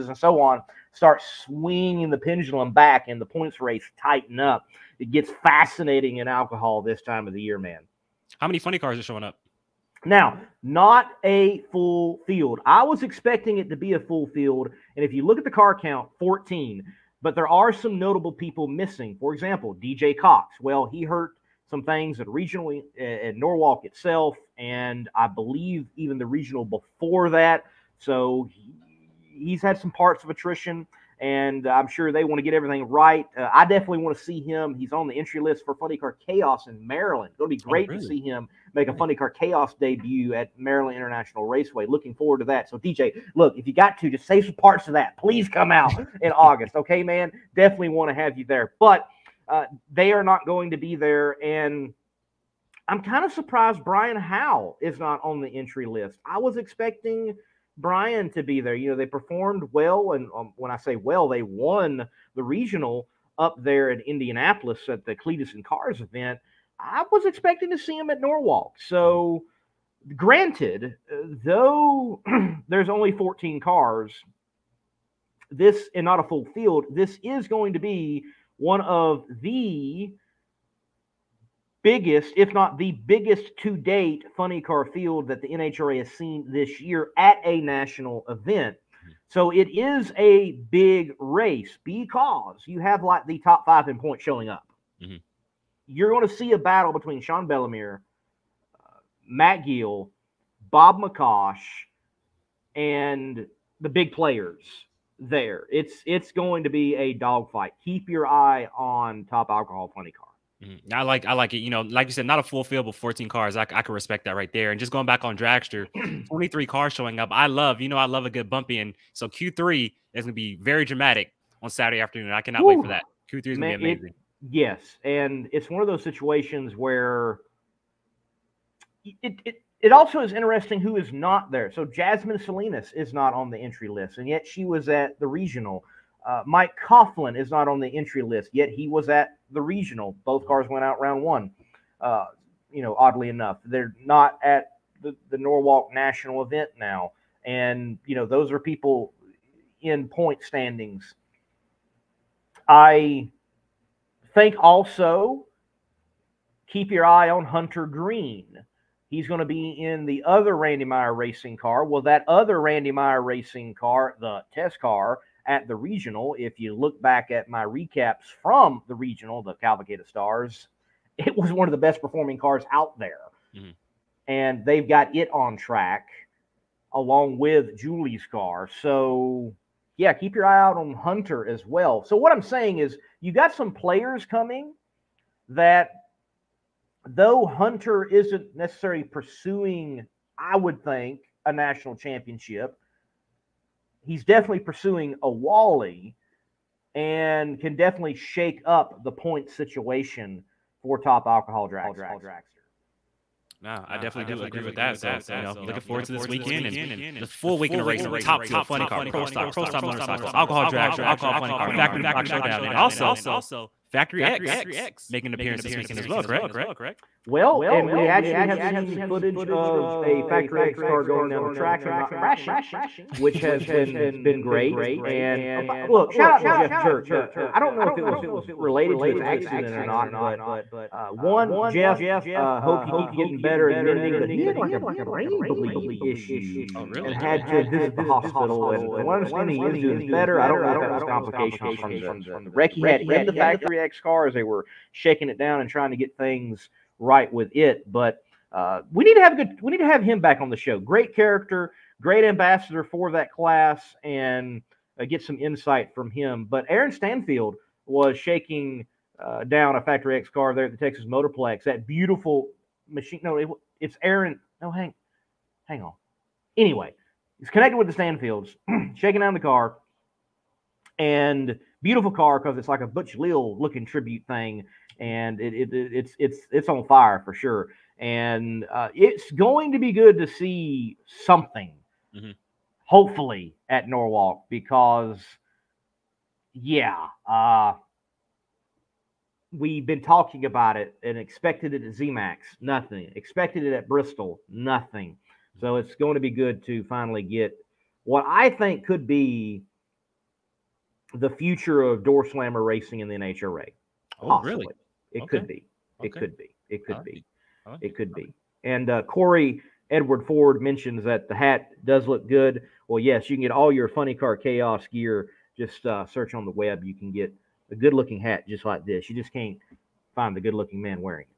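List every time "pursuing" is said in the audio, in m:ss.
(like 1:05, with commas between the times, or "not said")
3:09, 3:14.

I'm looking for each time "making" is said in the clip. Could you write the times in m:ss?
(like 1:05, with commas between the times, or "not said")
3:35.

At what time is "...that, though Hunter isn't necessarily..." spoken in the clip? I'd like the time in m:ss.
3:05.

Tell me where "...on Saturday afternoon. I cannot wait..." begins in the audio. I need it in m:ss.
2:01.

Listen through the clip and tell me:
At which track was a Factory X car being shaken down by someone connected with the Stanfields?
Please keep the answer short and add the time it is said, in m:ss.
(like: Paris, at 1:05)
Texas Motorplex, at 4:20.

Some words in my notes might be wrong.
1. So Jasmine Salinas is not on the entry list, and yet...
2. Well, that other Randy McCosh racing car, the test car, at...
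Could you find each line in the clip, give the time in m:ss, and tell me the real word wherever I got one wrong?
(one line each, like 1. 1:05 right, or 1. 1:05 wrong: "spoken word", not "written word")
1. 2:11 right
2. 2:41 wrong: "Meyer", not "McCosh".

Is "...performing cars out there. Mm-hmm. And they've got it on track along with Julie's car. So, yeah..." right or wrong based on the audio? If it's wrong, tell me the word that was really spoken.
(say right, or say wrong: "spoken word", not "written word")
right.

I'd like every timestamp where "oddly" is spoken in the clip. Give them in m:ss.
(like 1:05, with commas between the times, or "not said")
2:22.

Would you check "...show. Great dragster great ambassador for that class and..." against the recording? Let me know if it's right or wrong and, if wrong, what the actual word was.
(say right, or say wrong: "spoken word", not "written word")
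wrong: "character", not "dragster".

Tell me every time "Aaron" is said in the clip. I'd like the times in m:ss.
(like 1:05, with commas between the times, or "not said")
4:16, 4:24.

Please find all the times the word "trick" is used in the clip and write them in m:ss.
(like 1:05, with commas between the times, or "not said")
not said.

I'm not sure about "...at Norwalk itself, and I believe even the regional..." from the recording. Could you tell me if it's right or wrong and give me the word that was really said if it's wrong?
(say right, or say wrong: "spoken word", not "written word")
right.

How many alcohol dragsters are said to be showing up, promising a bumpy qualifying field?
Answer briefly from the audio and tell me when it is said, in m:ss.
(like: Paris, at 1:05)
23, at 1:56.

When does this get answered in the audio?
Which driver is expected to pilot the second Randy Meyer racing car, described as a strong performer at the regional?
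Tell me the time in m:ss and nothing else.
2:37.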